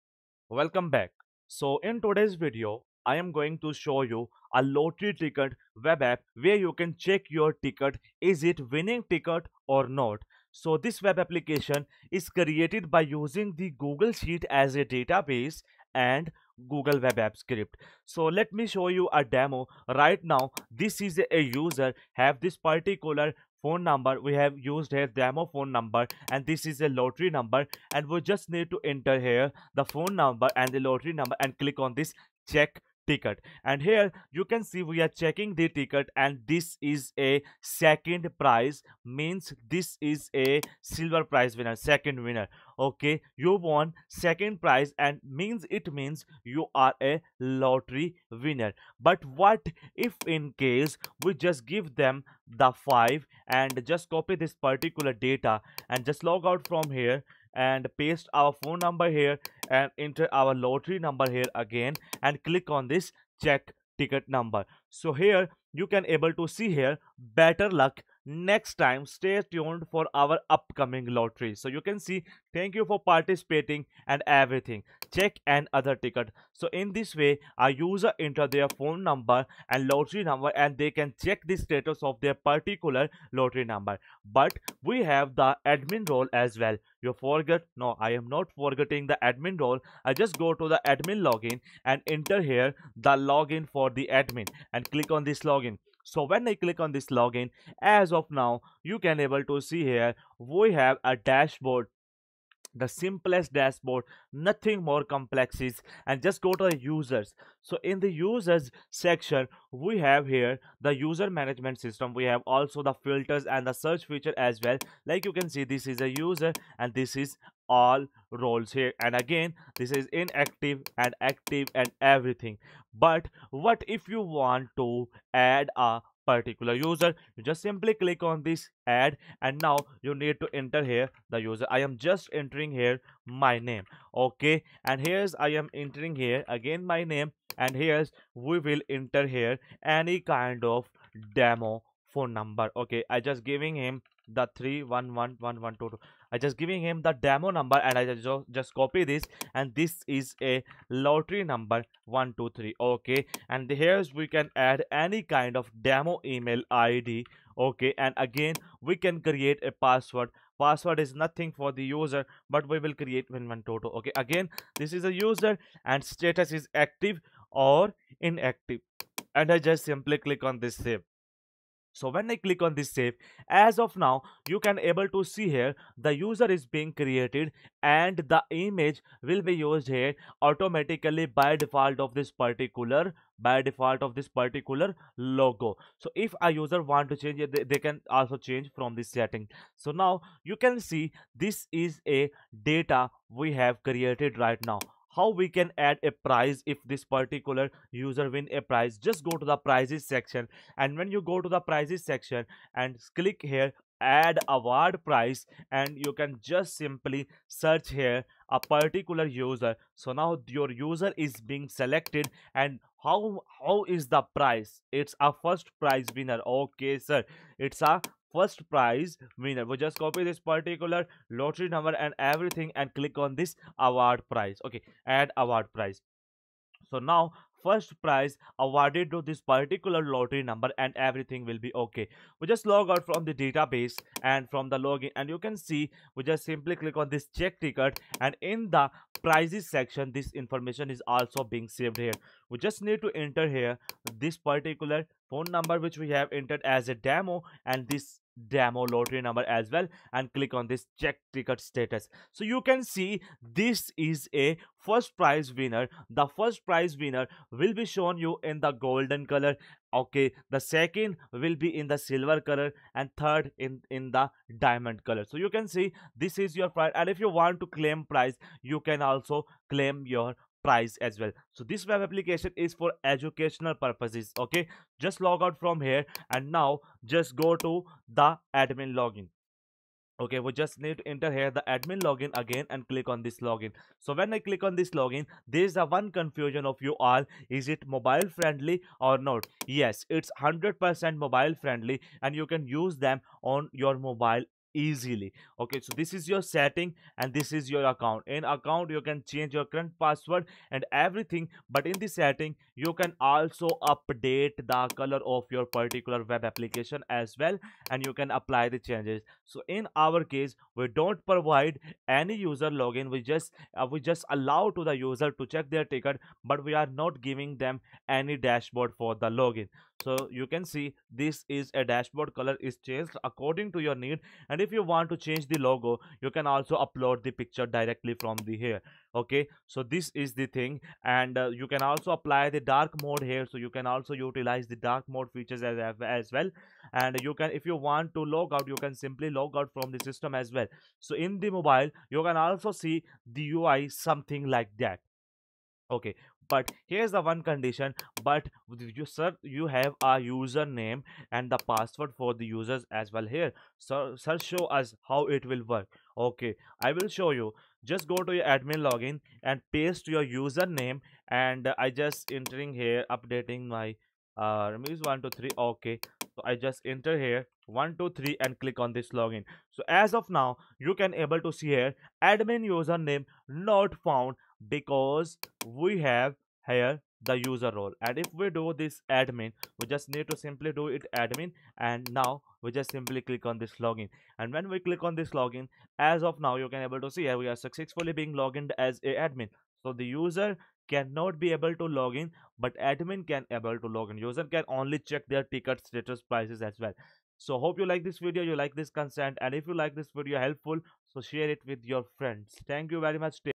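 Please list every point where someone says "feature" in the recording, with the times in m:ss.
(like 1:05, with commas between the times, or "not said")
1:54, 5:35.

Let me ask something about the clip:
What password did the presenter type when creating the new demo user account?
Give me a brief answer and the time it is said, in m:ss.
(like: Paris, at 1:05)
win win toto, at 2:43.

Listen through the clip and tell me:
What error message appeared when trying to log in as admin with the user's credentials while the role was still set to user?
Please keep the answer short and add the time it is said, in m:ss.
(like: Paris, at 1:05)
admin username not found, at 6:12.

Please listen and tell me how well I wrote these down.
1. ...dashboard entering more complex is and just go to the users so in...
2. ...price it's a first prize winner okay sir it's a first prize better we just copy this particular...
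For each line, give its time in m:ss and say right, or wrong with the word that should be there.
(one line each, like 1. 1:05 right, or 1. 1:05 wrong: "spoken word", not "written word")
1. 1:43 wrong: "nothing", not "entering"
2. 3:34 wrong: "winner", not "better".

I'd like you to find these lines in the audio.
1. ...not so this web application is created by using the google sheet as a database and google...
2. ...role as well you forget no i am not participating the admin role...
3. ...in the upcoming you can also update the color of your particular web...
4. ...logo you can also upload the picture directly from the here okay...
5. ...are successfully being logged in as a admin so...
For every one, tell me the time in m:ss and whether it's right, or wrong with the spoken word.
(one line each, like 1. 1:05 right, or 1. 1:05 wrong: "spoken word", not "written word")
1. 0:09 right
2. 1:26 wrong: "forgetting", not "participating"
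3. 5:01 wrong: "setting", not "upcoming"
4. 5:25 right
5. 6:27 right.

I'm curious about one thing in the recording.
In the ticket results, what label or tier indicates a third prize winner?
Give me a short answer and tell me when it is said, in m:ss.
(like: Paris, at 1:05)
Diamond, at 4:24.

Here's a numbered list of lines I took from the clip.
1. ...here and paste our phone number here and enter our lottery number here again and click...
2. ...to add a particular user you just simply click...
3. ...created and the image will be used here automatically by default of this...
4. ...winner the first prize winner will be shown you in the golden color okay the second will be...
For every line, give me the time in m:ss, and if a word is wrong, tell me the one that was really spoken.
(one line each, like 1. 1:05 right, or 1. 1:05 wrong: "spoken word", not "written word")
1. 0:56 right
2. 2:04 right
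3. 2:56 right
4. 4:15 right.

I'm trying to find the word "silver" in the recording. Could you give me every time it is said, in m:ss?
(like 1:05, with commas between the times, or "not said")
0:40, 4:21.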